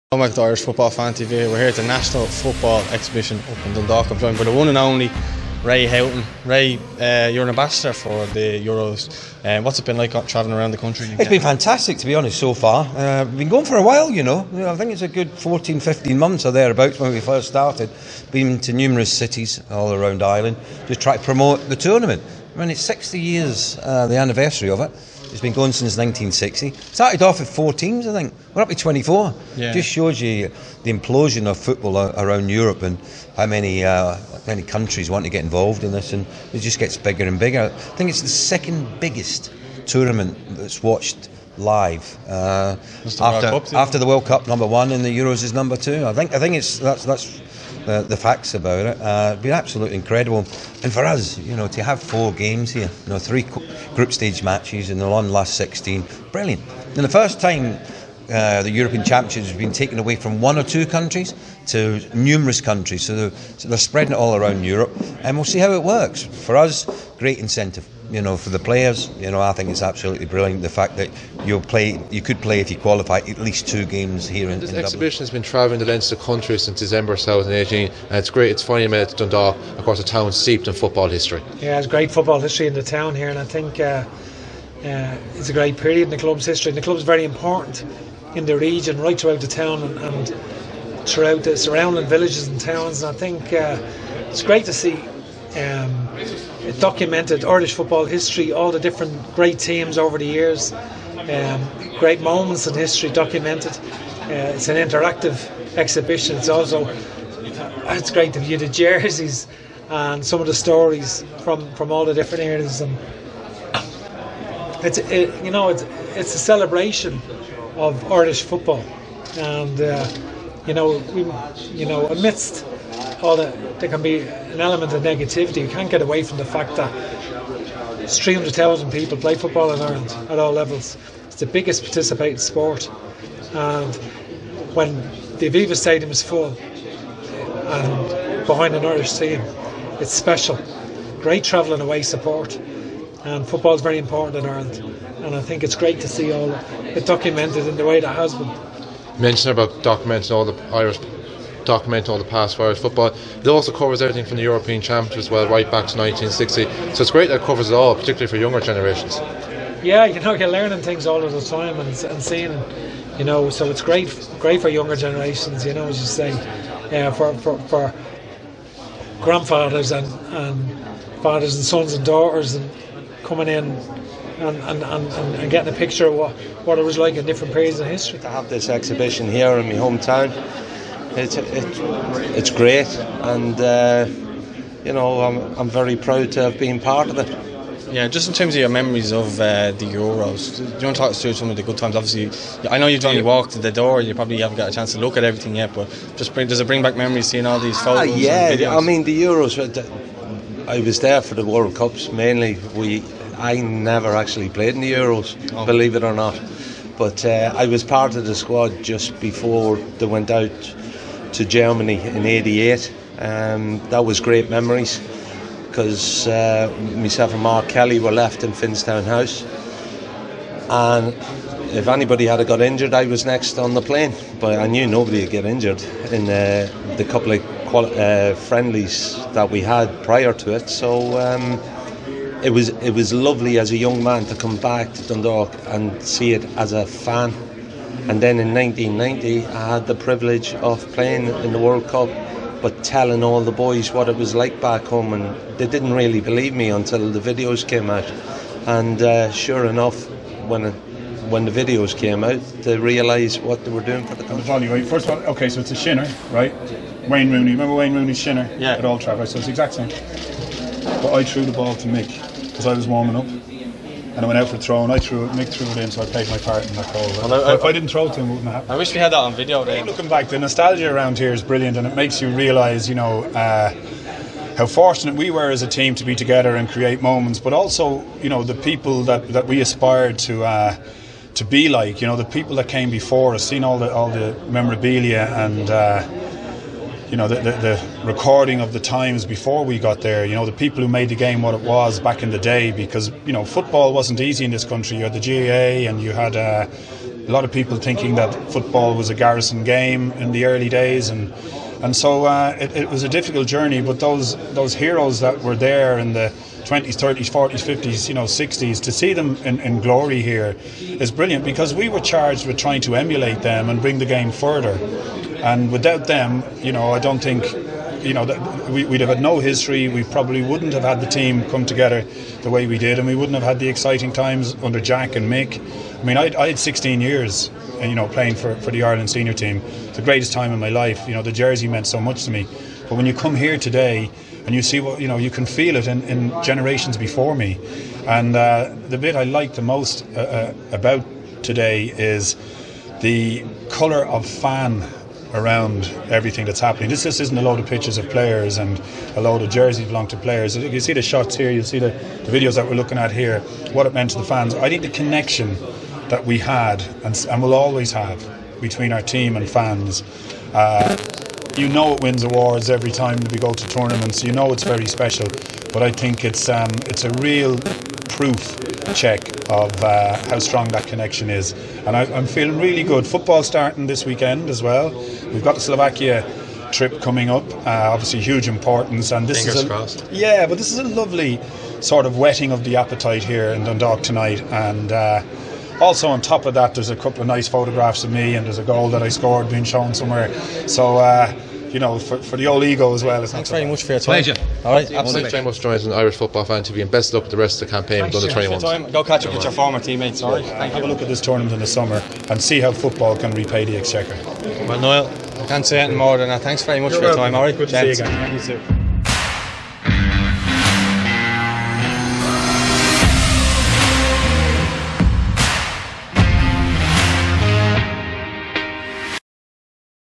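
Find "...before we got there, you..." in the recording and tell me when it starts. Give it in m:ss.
4:49.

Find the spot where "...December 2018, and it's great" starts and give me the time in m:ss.
1:16.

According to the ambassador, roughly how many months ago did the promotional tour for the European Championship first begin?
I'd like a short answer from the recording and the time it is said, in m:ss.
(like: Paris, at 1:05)
14, 15 months, at 0:15.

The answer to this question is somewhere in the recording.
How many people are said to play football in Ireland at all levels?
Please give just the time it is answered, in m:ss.
2:08.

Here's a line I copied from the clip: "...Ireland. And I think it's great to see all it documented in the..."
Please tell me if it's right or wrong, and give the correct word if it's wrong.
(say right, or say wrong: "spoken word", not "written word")
right.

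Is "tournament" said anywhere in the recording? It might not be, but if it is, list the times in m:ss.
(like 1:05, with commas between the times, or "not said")
0:21, 0:39, 6:03, 6:41.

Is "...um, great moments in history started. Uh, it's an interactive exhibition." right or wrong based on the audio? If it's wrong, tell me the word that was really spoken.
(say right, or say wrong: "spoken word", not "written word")
wrong: "documented", not "started".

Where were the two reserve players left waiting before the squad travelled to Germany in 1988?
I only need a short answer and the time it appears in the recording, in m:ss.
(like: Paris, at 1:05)
Finnstown House, at 3:38.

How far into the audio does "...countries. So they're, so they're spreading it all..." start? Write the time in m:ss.
1:02.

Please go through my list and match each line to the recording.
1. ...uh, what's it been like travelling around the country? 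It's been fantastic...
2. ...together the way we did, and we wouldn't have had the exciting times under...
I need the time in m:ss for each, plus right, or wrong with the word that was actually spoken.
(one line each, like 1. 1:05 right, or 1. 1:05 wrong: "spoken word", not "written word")
1. 0:09 right
2. 5:21 right.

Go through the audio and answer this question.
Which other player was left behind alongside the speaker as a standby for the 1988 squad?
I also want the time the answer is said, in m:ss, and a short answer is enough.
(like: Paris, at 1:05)
Mark Kelly, at 3:37.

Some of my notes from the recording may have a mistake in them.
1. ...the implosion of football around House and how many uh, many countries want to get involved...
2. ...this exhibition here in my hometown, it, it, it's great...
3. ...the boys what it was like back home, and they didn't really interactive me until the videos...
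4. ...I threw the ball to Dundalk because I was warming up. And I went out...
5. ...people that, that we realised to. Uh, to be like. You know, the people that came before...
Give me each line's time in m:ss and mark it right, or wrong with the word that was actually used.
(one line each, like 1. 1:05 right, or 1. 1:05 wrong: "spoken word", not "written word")
1. 0:30 wrong: "Europe", not "House"
2. 2:58 right
3. 4:03 wrong: "believe", not "interactive"
4. 4:21 wrong: "Mick", not "Dundalk"
5. 4:38 wrong: "aspired", not "realised".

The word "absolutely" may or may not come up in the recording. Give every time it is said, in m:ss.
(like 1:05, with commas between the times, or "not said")
0:49, 1:09, 6:34.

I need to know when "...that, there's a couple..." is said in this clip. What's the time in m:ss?
6:26.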